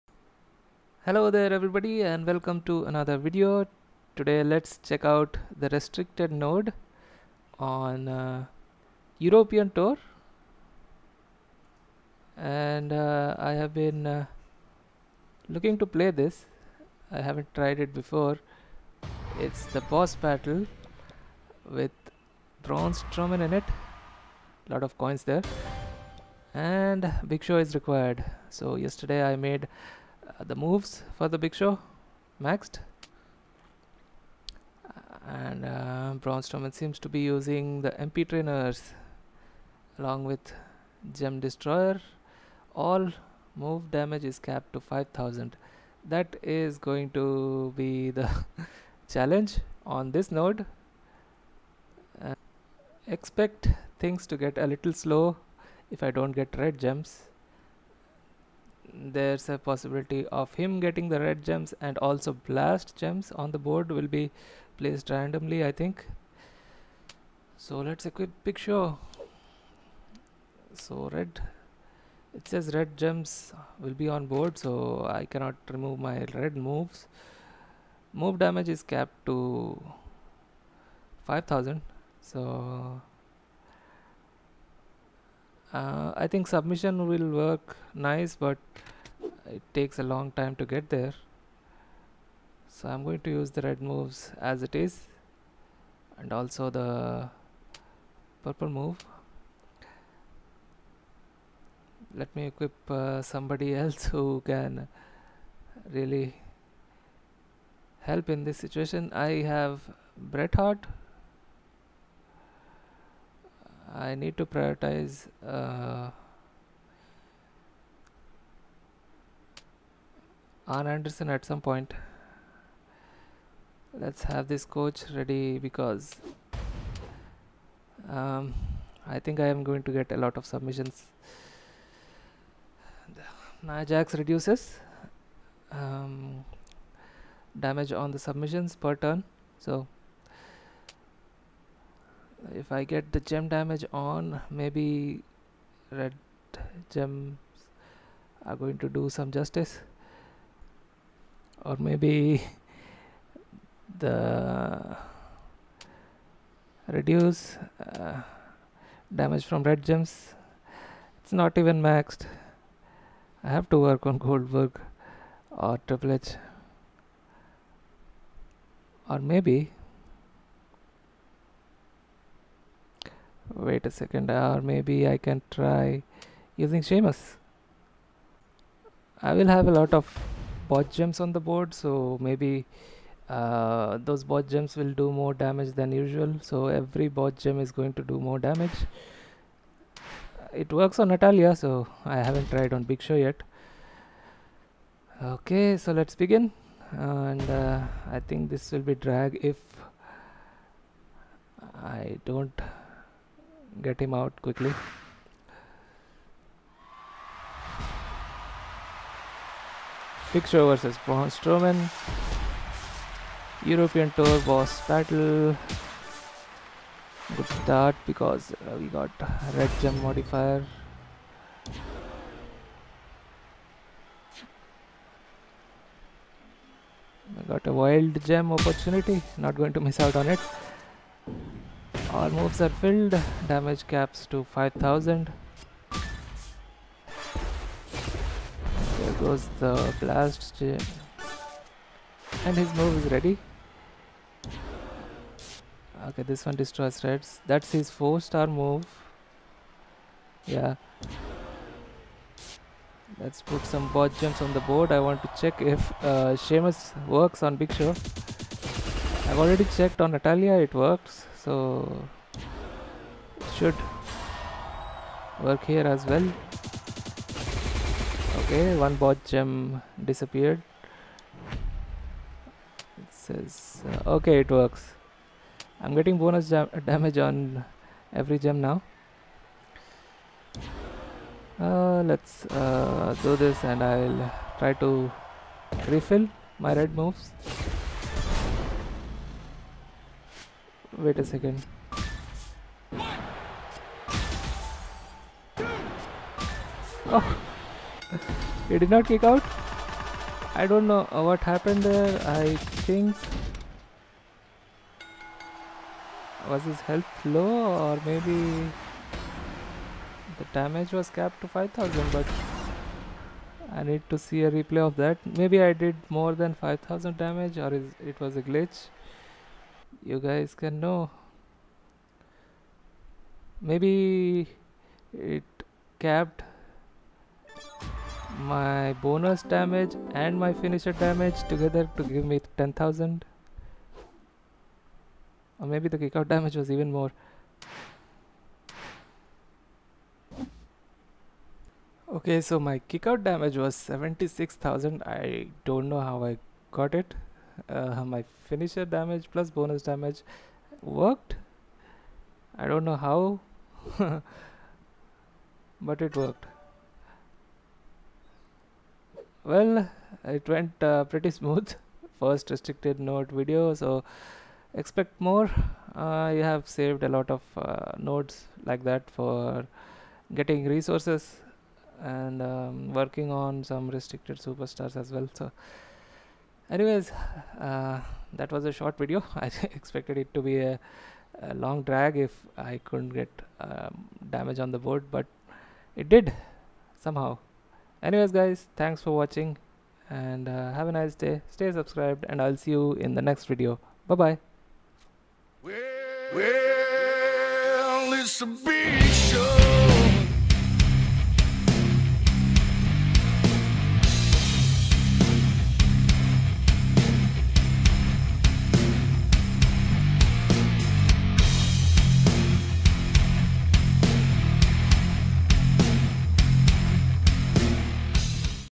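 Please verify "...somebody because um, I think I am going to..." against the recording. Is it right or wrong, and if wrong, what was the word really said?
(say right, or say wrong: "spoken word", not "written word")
wrong: "ready", not "somebody".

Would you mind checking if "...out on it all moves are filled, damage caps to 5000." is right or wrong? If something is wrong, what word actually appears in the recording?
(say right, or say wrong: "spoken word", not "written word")
right.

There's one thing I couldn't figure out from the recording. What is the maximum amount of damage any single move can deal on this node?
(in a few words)
5000.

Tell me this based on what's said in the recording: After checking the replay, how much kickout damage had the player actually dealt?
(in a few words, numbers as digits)
76,000.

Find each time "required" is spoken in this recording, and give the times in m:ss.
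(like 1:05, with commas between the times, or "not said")
0:27.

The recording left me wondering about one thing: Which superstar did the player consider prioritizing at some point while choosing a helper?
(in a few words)
Anderson.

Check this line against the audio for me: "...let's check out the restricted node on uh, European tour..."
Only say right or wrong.
right.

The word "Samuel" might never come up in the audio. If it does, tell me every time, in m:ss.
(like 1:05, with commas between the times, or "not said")
not said.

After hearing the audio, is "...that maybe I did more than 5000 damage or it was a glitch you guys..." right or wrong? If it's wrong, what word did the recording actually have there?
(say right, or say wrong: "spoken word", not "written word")
right.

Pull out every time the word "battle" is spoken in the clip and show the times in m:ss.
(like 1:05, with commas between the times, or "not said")
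0:20, 3:34.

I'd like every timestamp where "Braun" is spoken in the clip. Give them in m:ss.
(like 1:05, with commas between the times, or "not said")
0:22, 0:36, 3:31.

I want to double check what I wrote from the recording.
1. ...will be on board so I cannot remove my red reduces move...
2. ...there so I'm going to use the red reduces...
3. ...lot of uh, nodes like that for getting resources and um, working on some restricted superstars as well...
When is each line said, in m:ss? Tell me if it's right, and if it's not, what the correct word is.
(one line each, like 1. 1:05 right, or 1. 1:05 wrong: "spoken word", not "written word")
1. 1:13 wrong: "moves", not "reduces"
2. 1:30 wrong: "moves", not "reduces"
3. 6:07 right.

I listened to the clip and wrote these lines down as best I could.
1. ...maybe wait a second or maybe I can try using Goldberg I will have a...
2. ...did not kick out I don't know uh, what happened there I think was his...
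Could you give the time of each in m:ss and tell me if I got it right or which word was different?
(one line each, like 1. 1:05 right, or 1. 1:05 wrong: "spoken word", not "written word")
1. 2:49 wrong: "Sheamus", not "Goldberg"
2. 4:58 right.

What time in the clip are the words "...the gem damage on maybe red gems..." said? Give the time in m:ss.
2:23.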